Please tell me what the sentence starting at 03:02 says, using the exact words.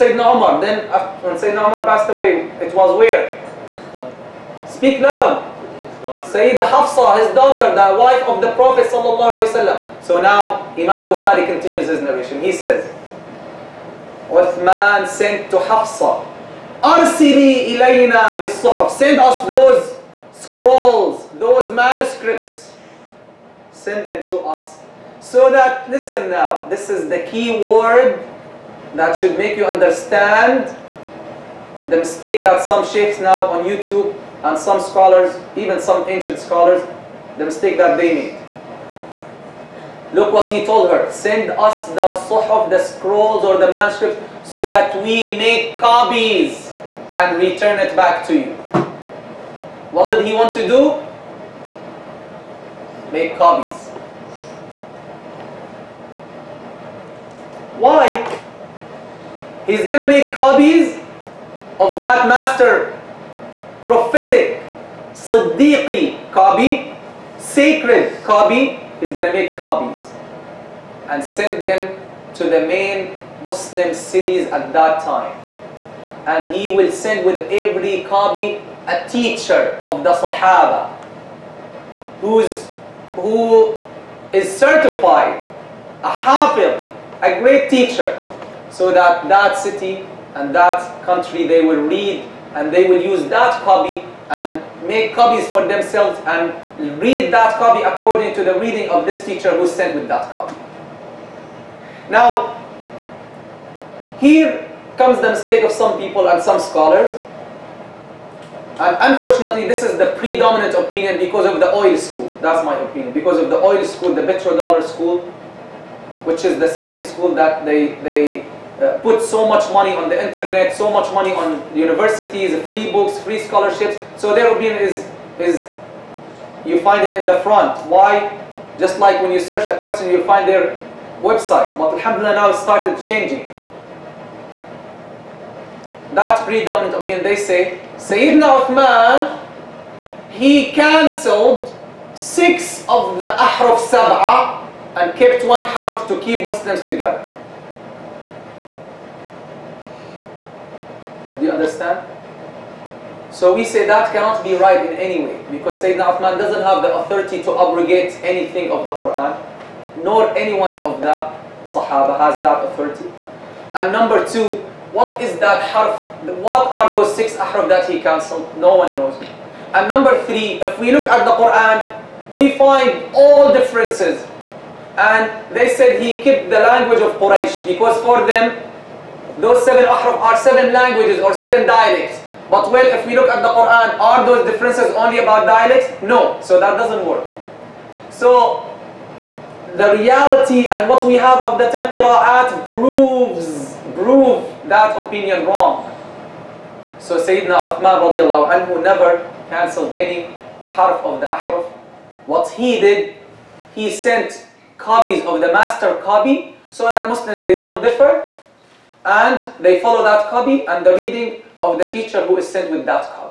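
But well, if we look at the Quran, are those differences only about dialects?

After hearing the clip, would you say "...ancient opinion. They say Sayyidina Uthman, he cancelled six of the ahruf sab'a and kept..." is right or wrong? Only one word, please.
wrong.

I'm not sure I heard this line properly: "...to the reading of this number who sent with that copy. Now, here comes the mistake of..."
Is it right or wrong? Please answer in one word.
wrong.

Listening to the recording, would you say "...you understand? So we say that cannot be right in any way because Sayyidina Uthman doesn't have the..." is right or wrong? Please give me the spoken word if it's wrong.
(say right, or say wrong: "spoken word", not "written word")
right.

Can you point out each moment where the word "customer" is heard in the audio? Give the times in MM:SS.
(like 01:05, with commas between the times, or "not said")
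not said.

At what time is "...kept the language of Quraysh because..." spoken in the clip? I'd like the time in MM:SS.
02:56.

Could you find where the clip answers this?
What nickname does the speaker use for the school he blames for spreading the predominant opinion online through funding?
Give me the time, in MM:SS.
01:54.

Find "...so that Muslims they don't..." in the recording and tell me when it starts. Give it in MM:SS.
03:26.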